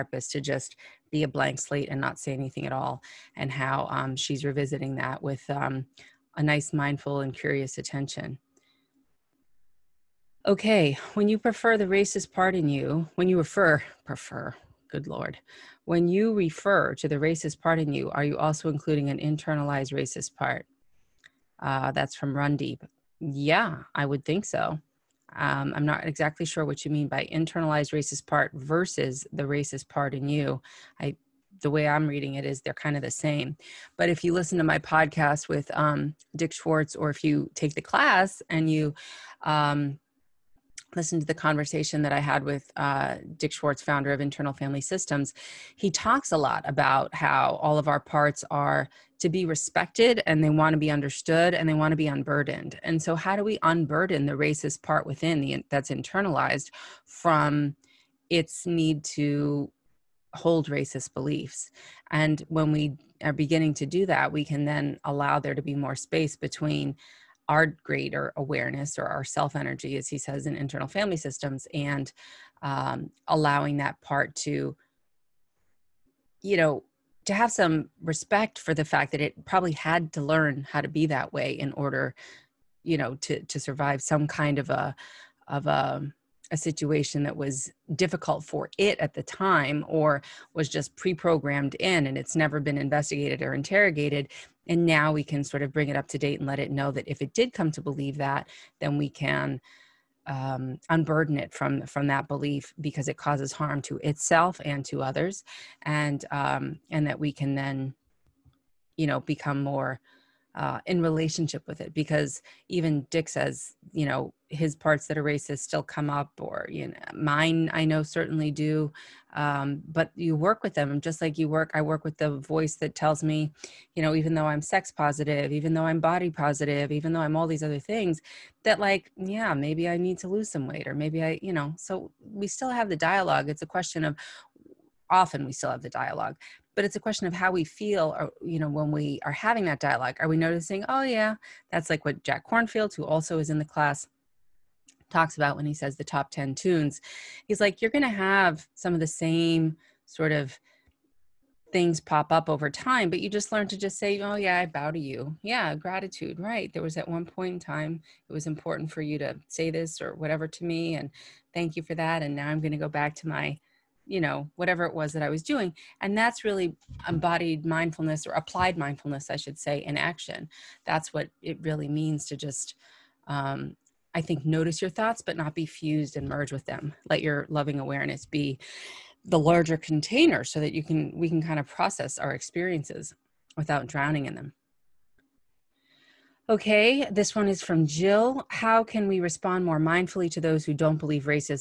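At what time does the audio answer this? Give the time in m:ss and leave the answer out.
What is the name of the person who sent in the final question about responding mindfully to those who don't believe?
3:07.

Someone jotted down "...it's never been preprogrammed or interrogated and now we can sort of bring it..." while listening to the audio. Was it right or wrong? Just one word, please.
wrong.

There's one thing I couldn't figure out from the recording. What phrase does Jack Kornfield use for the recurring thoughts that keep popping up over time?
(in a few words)
the top 10 tunes.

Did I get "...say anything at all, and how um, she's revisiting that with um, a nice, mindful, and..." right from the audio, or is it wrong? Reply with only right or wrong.
right.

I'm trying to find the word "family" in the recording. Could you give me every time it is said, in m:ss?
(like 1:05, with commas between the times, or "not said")
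0:44, 1:10.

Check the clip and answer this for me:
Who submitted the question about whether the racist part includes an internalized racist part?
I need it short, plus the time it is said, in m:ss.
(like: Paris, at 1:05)
Run Deep, at 0:22.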